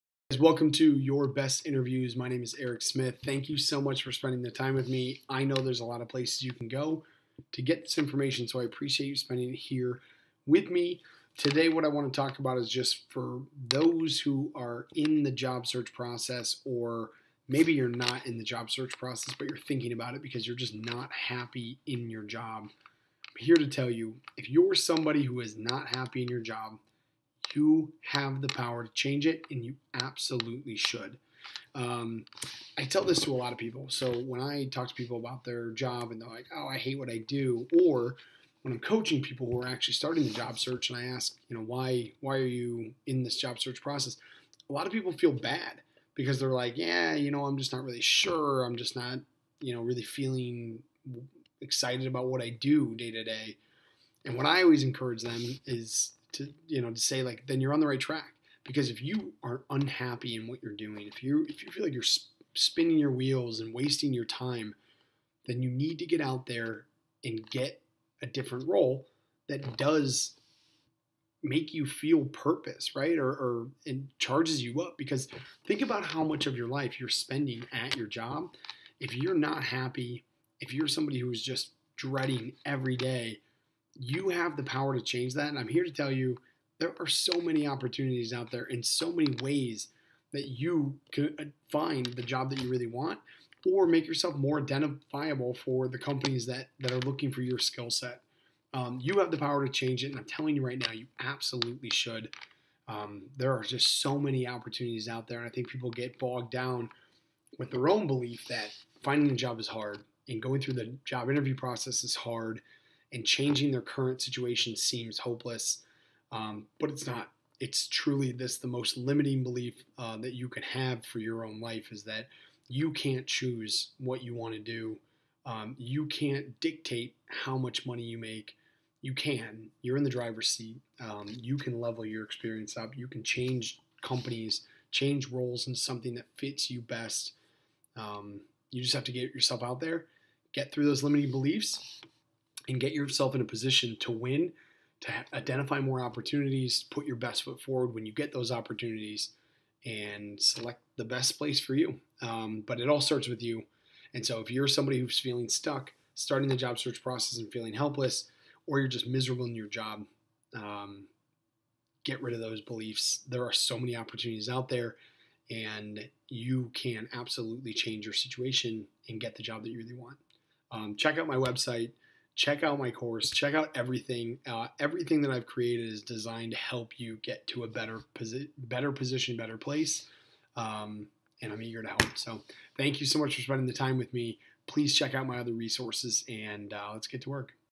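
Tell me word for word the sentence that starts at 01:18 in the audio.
If you're not happy, if you're somebody who's just dreading every day you have the power to change that.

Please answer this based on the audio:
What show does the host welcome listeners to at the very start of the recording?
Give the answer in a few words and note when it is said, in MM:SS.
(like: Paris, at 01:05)
Your Best Interviews, at 00:00.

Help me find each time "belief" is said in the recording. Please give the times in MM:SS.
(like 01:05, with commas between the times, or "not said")
01:48, 01:59, 02:21, 02:42.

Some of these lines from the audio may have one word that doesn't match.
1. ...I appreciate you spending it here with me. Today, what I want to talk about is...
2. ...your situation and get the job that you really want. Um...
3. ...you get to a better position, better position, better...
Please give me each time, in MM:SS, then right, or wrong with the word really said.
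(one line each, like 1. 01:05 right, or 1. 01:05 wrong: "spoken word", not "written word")
1. 00:08 right
2. 02:48 right
3. 02:56 right.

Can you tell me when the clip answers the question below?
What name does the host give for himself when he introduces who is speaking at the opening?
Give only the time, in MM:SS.
00:02.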